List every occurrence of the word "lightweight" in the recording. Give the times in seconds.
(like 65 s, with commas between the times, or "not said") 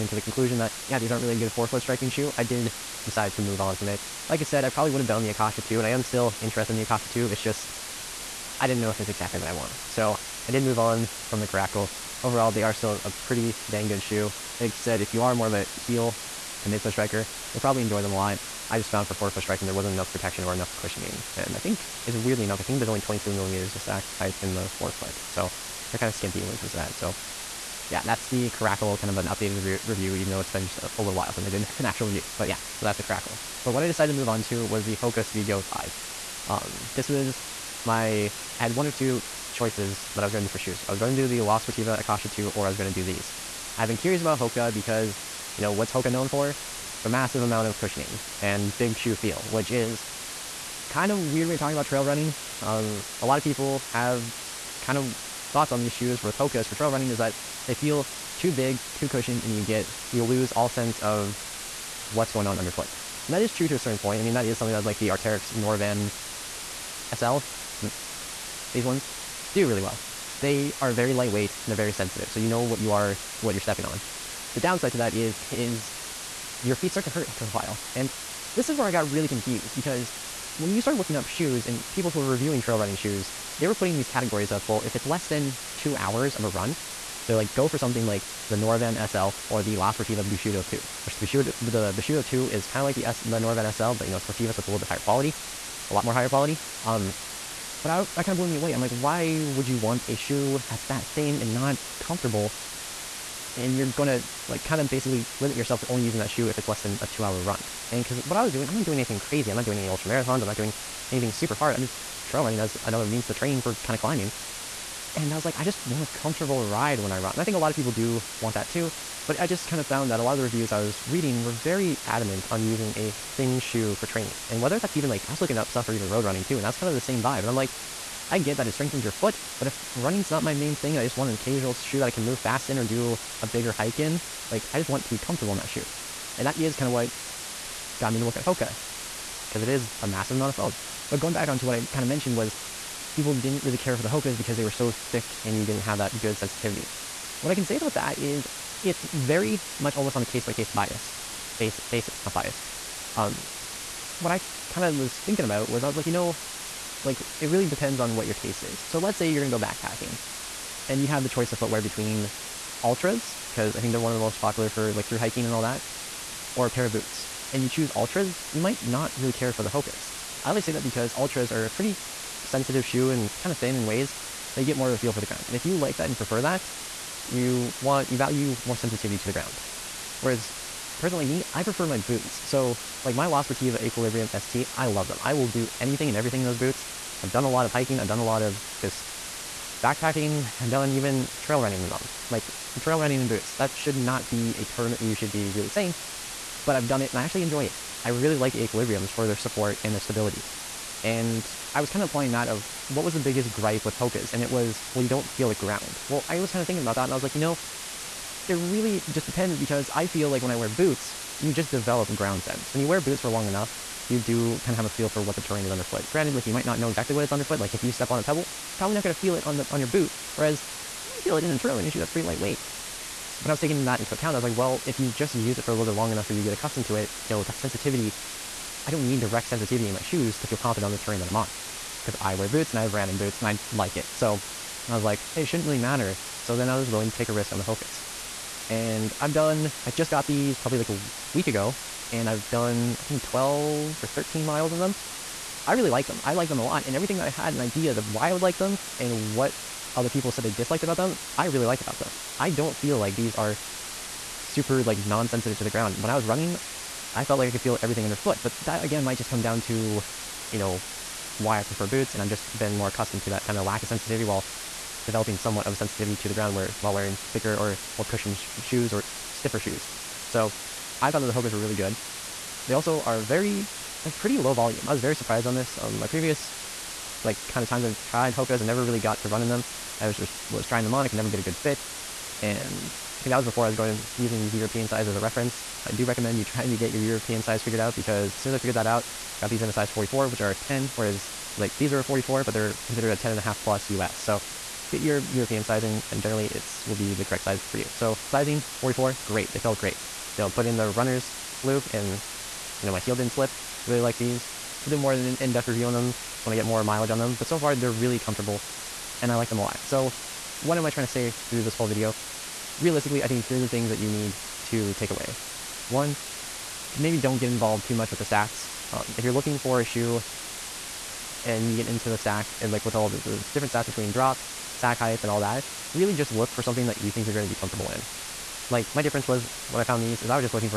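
71 s, 222 s.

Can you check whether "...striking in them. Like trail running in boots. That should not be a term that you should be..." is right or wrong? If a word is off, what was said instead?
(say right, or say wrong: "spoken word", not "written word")
wrong: "running", not "striking".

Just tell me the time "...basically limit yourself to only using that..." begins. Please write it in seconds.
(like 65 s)
104 s.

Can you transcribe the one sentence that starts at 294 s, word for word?
So get your European sizing and generally it's will be the correct size for you.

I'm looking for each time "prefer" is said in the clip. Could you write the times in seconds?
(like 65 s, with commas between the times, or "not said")
176 s, 181 s, 261 s.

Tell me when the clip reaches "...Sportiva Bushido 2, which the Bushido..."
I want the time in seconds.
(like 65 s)
89 s.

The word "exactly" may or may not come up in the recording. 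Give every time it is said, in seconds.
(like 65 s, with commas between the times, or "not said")
9 s, 216 s.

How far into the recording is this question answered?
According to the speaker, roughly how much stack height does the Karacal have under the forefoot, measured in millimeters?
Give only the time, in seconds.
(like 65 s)
23 s.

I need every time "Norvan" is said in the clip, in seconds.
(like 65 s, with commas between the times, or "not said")
65 s, 88 s, 93 s.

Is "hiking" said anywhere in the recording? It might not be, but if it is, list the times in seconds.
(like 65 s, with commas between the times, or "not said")
165 s, 187 s.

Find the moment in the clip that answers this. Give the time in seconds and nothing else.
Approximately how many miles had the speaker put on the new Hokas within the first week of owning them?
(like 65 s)
243 s.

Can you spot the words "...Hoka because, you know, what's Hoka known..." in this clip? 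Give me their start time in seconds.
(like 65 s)
44 s.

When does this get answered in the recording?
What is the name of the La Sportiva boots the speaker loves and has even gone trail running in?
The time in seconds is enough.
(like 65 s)
183 s.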